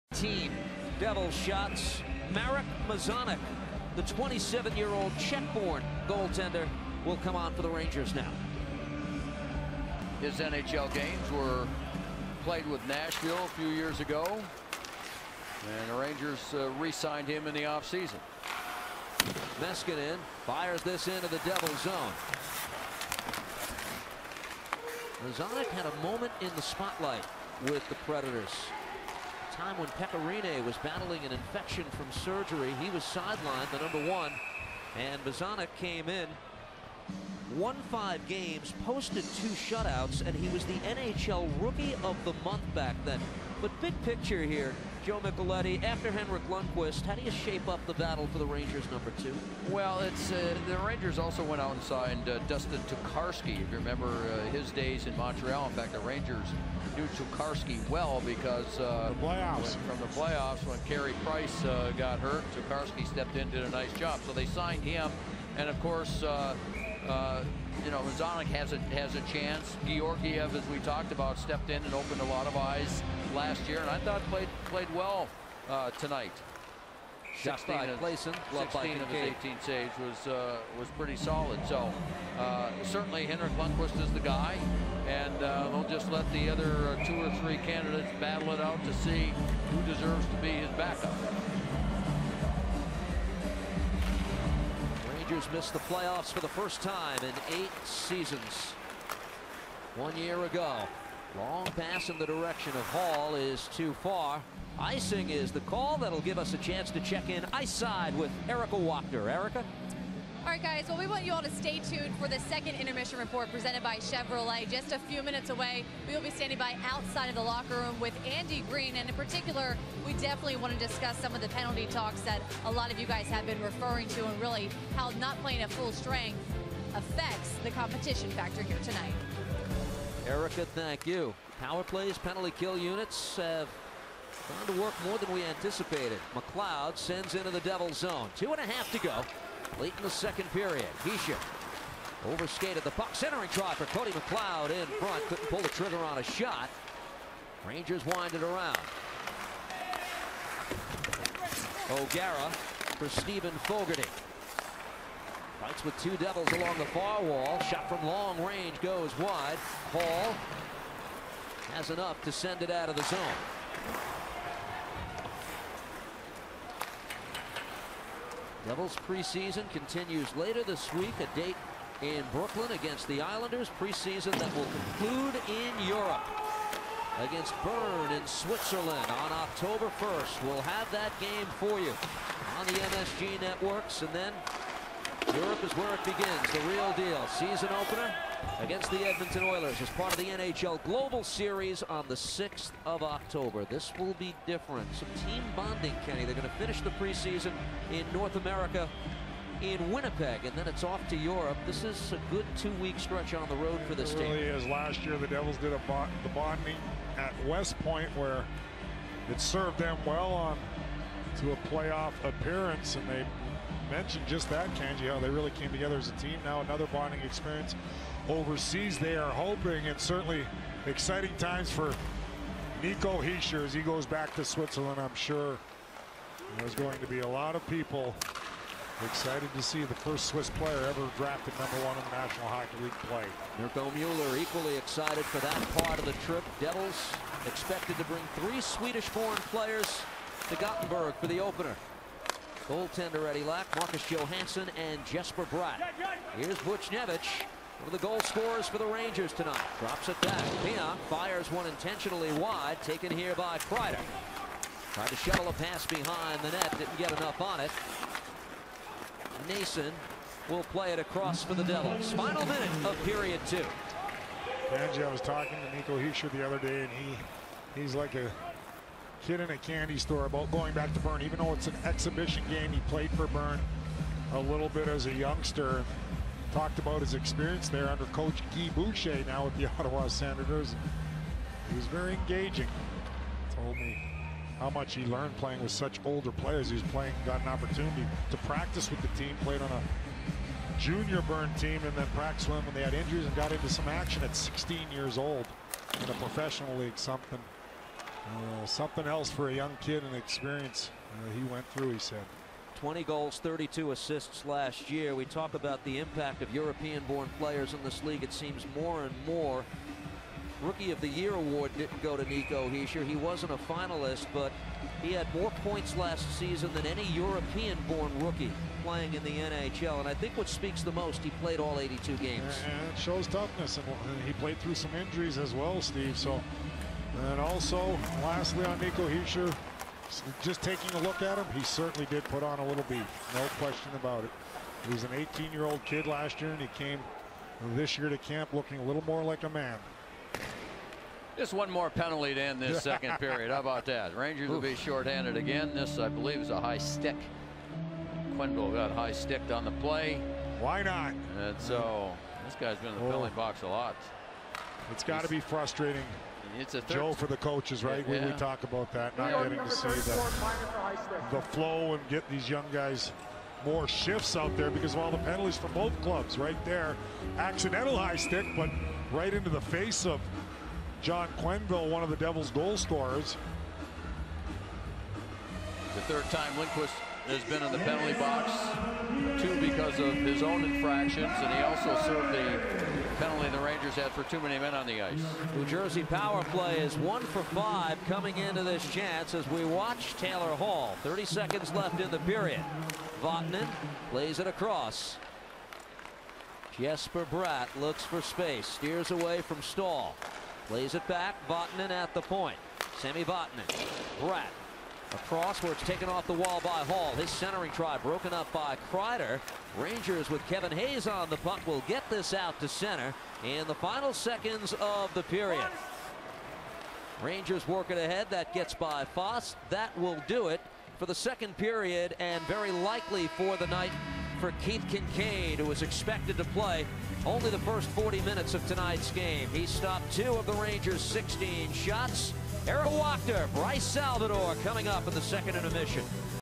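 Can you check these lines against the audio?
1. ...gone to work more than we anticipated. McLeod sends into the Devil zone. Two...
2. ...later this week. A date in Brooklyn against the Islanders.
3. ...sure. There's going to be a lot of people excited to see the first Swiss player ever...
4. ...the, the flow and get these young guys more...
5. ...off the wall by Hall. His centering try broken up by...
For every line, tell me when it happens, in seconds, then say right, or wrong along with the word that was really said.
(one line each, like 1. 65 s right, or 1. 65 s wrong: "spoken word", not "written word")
1. 134 s right
2. 170 s right
3. 225 s right
4. 359 s right
5. 406 s right.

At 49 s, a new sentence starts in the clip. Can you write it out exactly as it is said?
Well, it's uh, the Rangers also went out and signed uh, Dustin Tokarski.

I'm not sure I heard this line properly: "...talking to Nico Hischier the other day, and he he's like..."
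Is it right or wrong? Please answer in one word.
right.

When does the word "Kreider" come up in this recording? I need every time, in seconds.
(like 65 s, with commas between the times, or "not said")
253 s, 408 s.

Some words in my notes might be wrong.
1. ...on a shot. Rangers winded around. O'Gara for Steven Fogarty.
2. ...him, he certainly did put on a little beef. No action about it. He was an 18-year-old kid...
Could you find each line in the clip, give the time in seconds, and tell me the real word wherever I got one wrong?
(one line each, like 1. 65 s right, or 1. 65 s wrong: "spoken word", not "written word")
1. 145 s right
2. 331 s wrong: "question", not "action".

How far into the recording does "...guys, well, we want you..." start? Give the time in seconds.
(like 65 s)
110 s.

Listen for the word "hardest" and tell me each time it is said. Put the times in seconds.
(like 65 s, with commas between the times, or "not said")
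not said.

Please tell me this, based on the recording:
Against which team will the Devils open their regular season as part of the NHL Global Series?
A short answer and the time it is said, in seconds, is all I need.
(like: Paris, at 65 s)
Edmonton Oilers, at 189 s.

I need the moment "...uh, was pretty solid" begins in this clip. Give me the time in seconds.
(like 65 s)
80 s.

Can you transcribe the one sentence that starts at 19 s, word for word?
Meskinen fires this into the Devil zone.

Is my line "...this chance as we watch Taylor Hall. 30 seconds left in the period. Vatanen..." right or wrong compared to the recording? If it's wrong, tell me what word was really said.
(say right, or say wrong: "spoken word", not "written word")
right.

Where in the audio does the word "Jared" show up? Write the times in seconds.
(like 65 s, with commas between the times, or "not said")
not said.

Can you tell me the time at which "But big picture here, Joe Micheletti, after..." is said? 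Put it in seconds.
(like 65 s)
43 s.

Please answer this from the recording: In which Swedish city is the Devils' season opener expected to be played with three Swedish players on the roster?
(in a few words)
Gothenburg.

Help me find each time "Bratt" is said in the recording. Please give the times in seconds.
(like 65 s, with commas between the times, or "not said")
245 s, 397 s, 404 s.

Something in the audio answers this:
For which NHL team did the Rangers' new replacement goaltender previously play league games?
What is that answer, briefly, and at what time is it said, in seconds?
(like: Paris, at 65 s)
Nashville, at 12 s.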